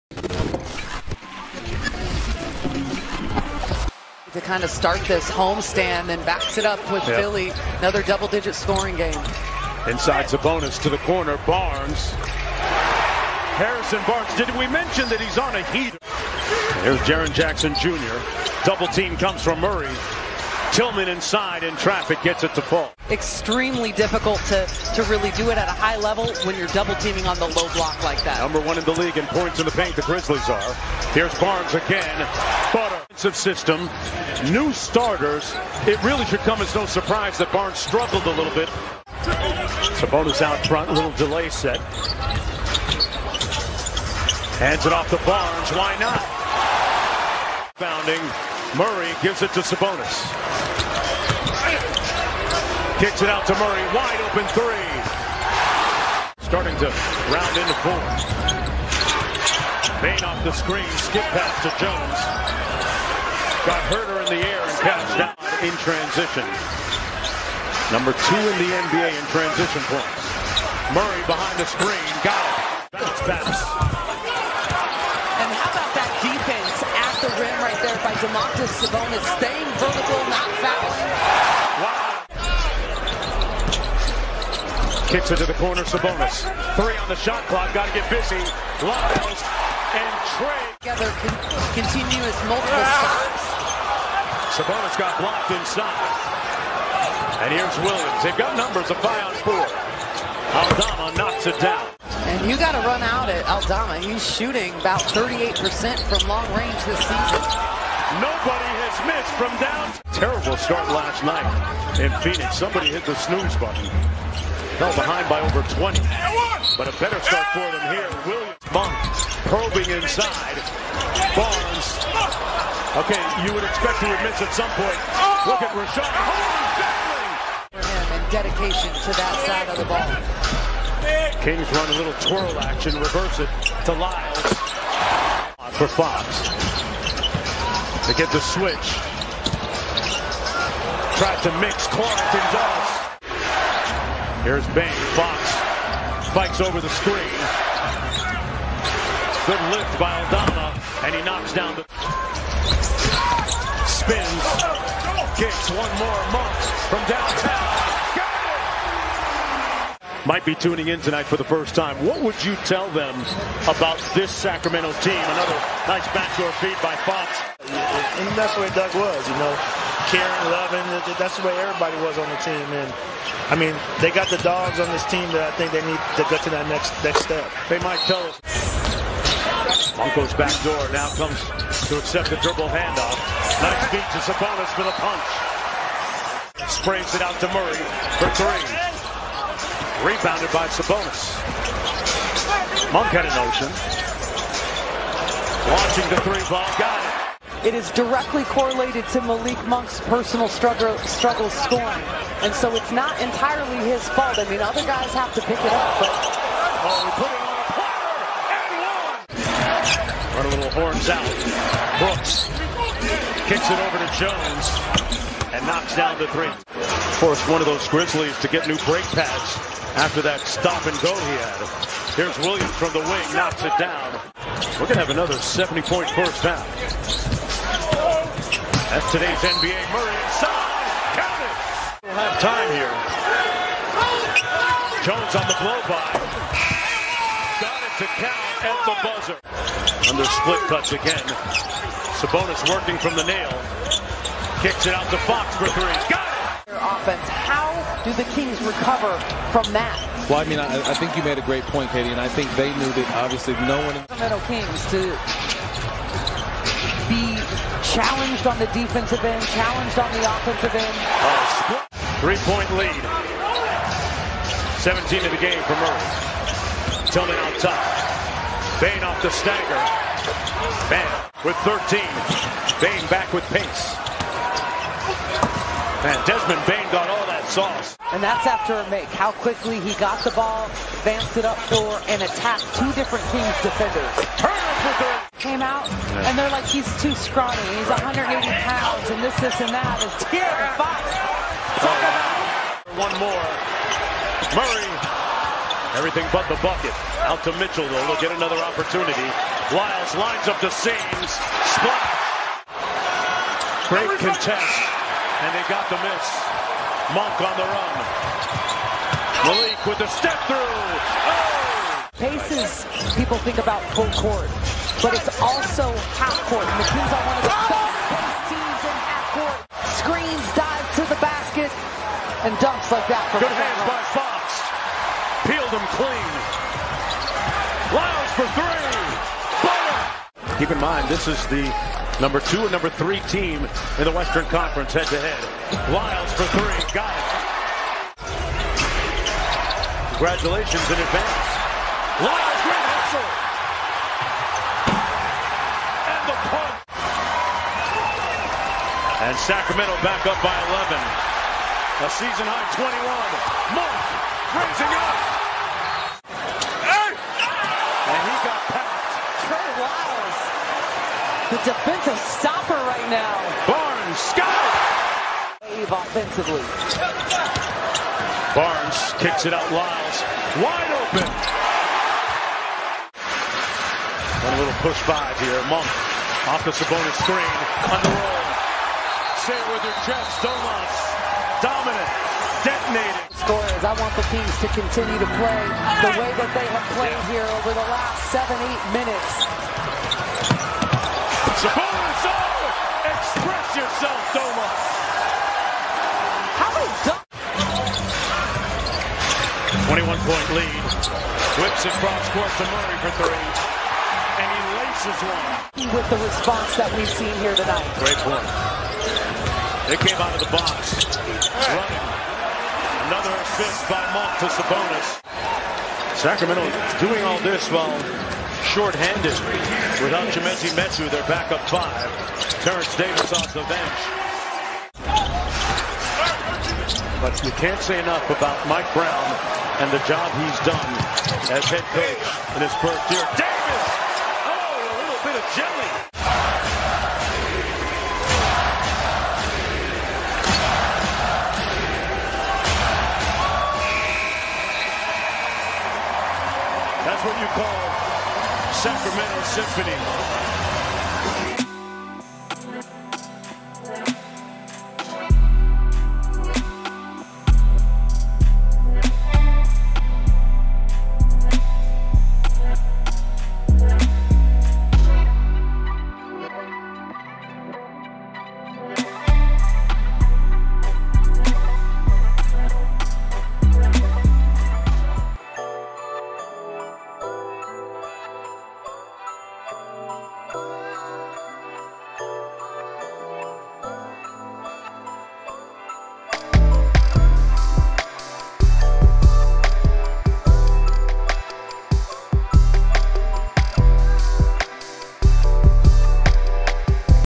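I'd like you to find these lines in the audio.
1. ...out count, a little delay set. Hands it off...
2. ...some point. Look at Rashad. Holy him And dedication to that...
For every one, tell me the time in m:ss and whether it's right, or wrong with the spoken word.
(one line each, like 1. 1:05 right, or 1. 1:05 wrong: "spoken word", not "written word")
1. 0:40 wrong: "front", not "count"
2. 2:04 right.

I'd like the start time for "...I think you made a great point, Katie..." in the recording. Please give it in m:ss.
4:10.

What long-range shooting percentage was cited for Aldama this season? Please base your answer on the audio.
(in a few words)
38%.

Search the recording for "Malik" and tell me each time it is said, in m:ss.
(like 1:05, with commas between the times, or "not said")
3:19, 5:09.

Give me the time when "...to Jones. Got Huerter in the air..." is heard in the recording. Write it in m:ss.
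1:01.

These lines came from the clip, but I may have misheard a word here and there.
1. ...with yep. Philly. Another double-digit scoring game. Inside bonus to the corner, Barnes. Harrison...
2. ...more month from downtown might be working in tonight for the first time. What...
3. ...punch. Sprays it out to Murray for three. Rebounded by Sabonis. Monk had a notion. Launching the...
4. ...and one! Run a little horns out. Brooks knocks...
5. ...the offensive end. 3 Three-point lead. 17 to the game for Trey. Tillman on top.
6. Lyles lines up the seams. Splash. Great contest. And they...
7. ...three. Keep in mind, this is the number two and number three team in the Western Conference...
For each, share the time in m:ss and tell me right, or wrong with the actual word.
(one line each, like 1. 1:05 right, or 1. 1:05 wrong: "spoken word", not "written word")
1. 0:06 right
2. 2:35 wrong: "tuning", not "working"
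3. 3:04 right
4. 3:30 wrong: "kicks", not "knocks"
5. 4:20 wrong: "Murray", not "Trey"
6. 4:59 right
7. 5:28 right.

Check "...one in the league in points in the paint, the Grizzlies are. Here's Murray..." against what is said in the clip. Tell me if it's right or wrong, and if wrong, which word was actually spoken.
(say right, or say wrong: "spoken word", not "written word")
wrong: "Barnes", not "Murray".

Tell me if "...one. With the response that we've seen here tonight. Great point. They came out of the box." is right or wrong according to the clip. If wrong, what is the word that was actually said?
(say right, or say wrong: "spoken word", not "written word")
right.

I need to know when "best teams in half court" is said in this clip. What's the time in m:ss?
5:17.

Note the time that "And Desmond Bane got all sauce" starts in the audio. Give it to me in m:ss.
4:36.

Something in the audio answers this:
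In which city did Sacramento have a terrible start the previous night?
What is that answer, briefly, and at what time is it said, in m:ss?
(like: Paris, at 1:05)
Phoenix, at 1:52.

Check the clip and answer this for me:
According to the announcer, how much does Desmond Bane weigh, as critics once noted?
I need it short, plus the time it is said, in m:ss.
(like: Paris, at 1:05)
180 pounds, at 4:47.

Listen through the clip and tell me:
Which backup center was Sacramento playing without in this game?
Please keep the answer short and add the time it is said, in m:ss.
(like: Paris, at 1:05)
Chimezie Metu, at 7:00.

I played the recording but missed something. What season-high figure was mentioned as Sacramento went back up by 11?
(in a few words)
21.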